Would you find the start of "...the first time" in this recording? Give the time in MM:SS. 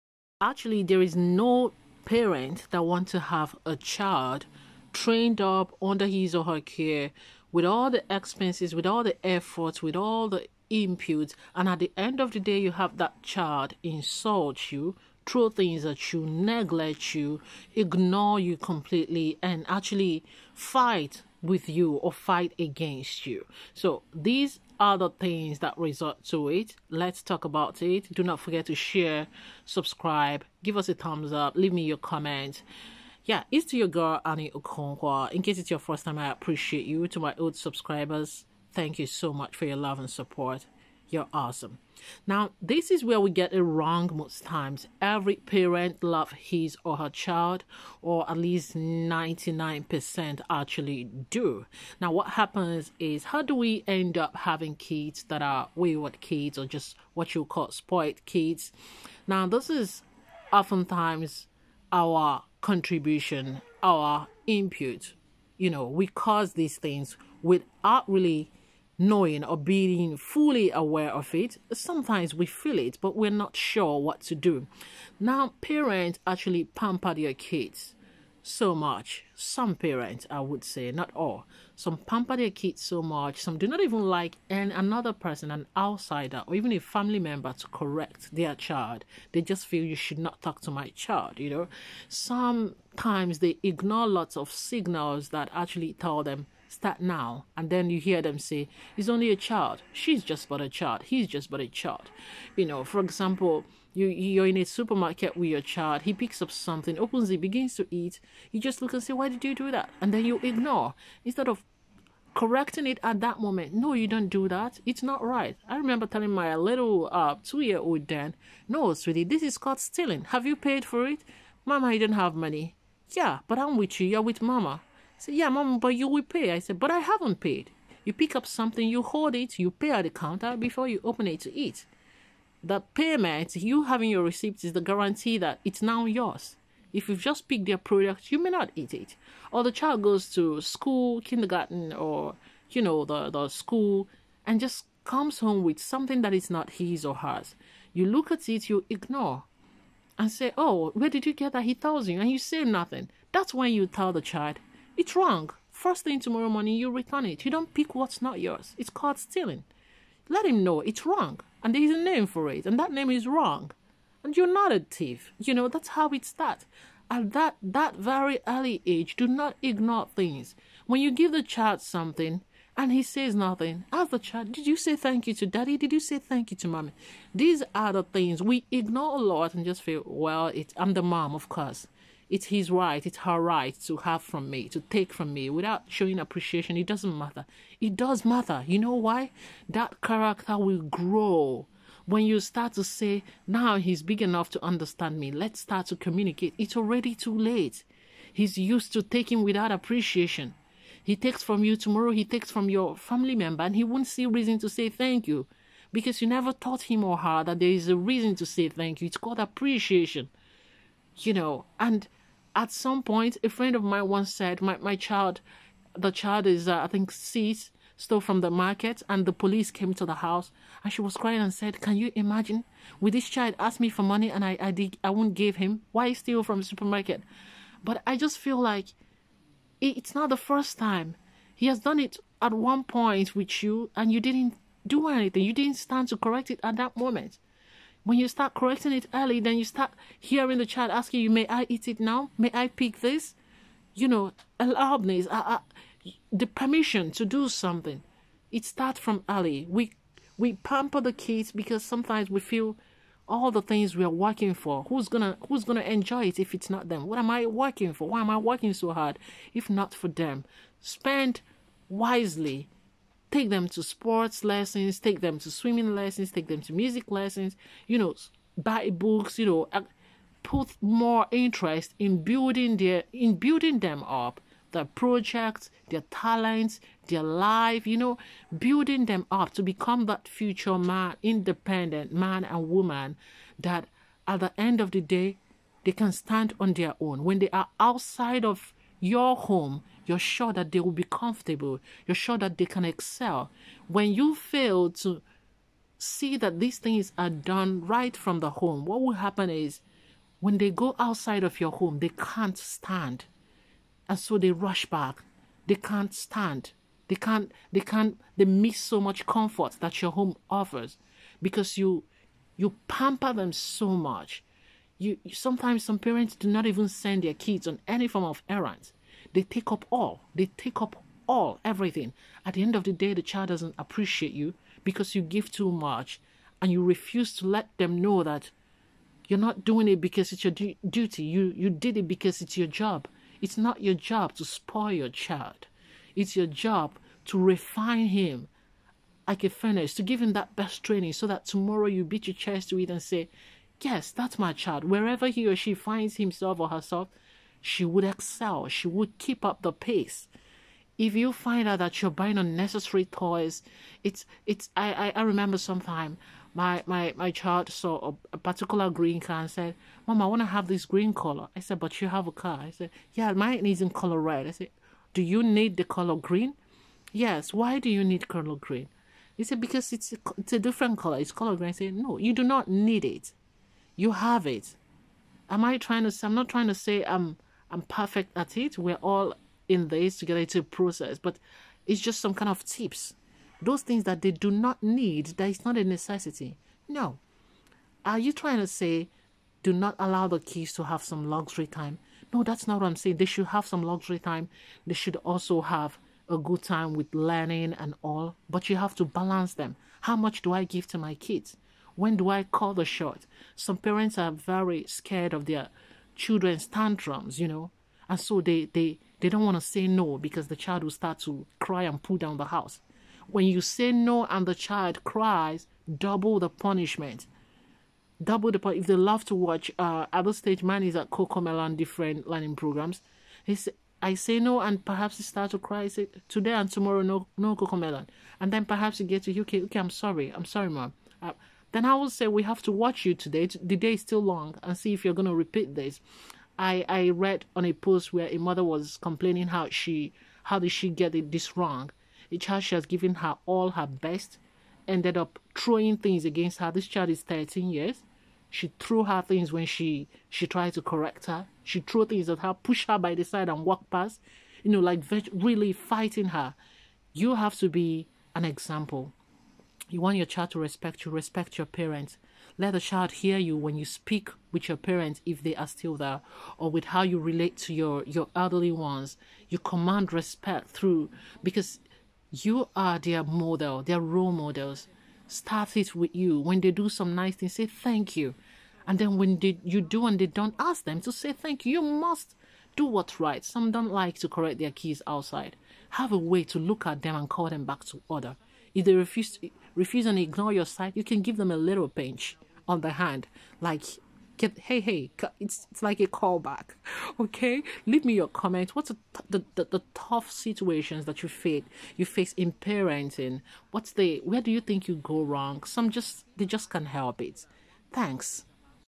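03:50.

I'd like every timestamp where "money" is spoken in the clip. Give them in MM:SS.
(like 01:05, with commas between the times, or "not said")
02:02, 03:44.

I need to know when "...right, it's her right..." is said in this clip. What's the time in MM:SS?
03:02.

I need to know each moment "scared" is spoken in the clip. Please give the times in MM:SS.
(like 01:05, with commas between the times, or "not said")
06:44.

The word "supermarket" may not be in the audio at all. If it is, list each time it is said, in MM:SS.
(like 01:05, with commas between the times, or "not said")
01:44, 03:46.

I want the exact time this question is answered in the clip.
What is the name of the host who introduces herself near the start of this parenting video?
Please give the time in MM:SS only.
00:34.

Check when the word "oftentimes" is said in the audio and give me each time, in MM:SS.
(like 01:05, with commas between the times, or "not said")
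01:00.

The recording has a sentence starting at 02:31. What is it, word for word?
He tells you, and you say nothing.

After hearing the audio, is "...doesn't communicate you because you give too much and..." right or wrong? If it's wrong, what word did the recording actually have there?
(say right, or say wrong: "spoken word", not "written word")
wrong: "appreciate", not "communicate".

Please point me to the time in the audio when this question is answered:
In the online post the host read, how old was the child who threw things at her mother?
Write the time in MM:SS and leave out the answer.
07:27.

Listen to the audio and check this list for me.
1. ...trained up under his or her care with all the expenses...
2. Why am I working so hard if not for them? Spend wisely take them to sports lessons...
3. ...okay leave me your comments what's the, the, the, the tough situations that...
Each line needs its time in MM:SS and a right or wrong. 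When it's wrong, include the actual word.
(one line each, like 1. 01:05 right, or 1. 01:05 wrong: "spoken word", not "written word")
1. 00:04 right
2. 04:18 right
3. 08:17 right.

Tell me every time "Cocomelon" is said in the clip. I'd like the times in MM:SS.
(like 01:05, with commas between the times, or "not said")
07:01, 07:07.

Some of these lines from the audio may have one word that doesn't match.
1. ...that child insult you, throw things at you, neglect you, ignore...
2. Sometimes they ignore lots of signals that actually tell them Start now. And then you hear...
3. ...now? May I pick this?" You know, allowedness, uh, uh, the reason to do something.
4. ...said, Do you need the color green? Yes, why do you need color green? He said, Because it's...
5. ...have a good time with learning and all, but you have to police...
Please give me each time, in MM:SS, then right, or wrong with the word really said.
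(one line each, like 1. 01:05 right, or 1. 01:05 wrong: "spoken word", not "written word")
1. 00:12 right
2. 01:32 right
3. 04:01 wrong: "permission", not "reason"
4. 06:04 right
5. 06:35 wrong: "balance", not "police".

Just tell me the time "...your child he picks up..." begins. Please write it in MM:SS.
01:45.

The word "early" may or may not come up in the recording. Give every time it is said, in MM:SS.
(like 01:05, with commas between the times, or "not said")
02:48, 03:59, 04:09.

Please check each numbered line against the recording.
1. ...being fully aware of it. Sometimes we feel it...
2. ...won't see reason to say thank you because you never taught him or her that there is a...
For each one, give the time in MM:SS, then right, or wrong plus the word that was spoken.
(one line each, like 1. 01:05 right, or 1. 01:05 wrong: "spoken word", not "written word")
1. 01:09 right
2. 03:23 right.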